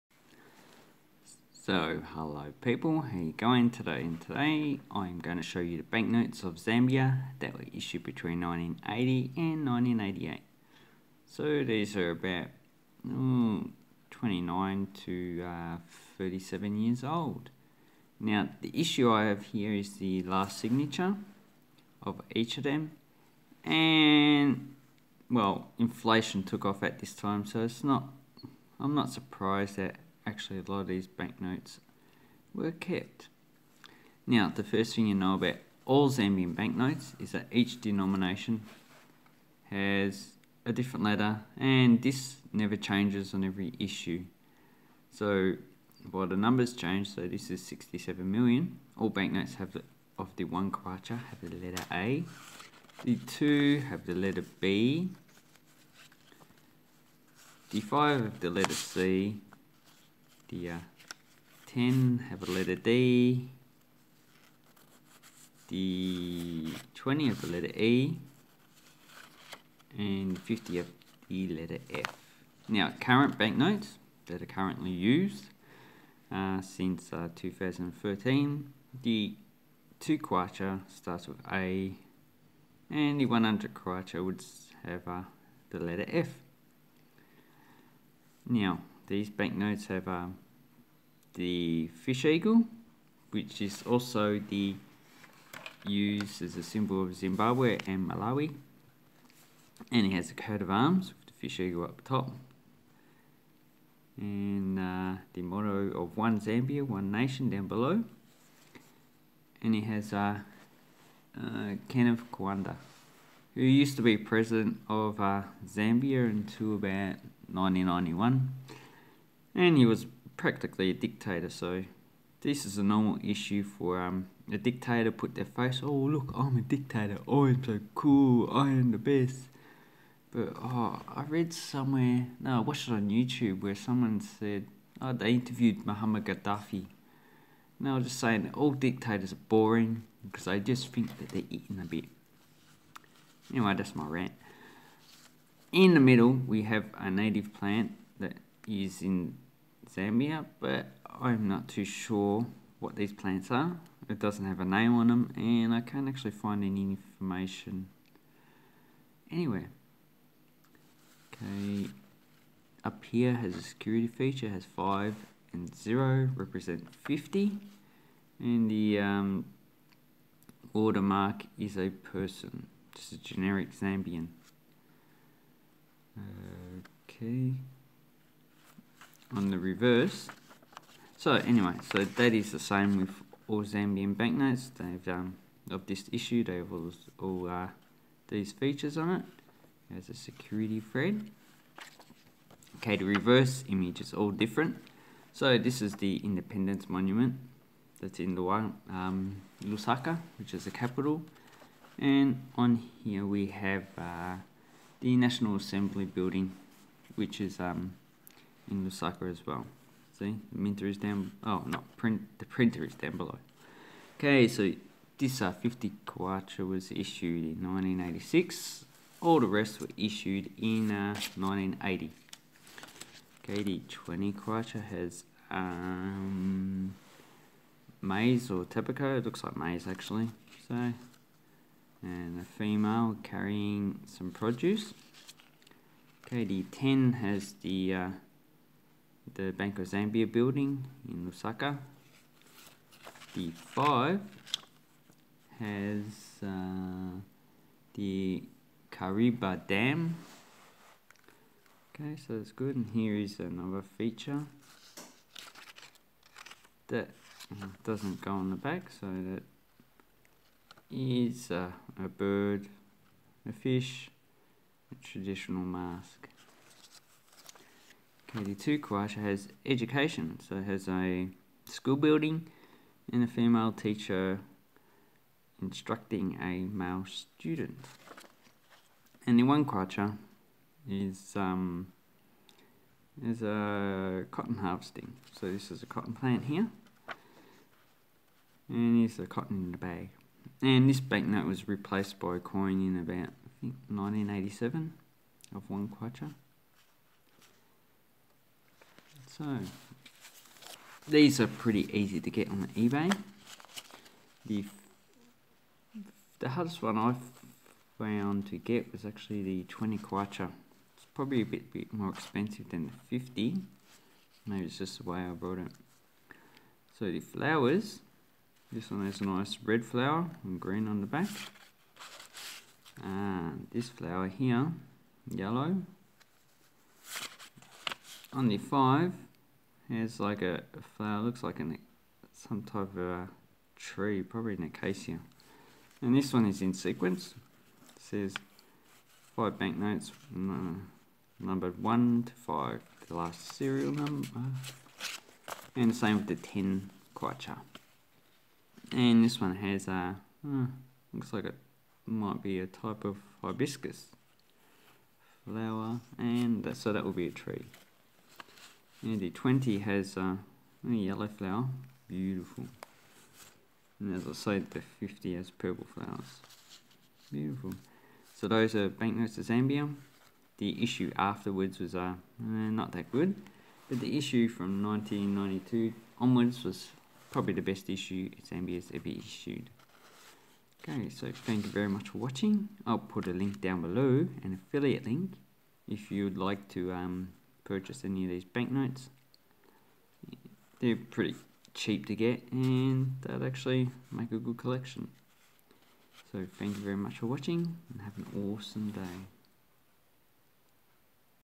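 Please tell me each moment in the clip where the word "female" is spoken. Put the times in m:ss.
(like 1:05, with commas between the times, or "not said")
3:52, 4:33.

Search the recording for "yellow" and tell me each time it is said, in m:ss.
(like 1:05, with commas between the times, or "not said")
5:25, 6:00.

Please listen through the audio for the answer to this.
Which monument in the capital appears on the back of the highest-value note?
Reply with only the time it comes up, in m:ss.
3:16.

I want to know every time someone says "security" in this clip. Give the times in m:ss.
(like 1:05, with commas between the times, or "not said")
2:43, 3:10.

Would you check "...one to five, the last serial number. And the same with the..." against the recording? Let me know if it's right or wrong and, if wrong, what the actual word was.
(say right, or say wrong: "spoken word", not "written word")
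right.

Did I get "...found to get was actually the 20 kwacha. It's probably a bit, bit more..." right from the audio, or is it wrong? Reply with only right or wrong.
right.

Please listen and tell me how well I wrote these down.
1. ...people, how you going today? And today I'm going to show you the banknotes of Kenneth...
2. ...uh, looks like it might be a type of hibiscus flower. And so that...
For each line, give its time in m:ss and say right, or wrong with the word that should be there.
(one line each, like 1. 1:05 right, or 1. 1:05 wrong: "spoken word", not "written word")
1. 0:02 wrong: "Zambia", not "Kenneth"
2. 5:50 right.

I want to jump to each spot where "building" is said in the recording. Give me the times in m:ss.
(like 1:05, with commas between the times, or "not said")
3:26, 4:00, 4:31.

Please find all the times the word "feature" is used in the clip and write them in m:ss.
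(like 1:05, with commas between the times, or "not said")
2:44, 3:08, 4:13.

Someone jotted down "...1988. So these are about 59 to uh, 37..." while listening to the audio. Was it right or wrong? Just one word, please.
wrong.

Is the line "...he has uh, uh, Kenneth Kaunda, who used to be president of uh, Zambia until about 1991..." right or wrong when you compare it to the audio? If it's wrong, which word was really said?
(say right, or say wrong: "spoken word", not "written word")
right.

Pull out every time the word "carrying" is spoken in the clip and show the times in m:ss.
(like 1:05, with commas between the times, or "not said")
3:53.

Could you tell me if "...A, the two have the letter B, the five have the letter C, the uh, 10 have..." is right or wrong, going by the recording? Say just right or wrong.
right.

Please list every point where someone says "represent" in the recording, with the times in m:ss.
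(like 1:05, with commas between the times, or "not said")
2:46.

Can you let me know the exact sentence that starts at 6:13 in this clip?
But the issue from 1992 onwards was probably the best issue Zambia's ever issued.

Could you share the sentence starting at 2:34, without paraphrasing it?
It doesn't have a name on them, and I can't actually find any information anywhere.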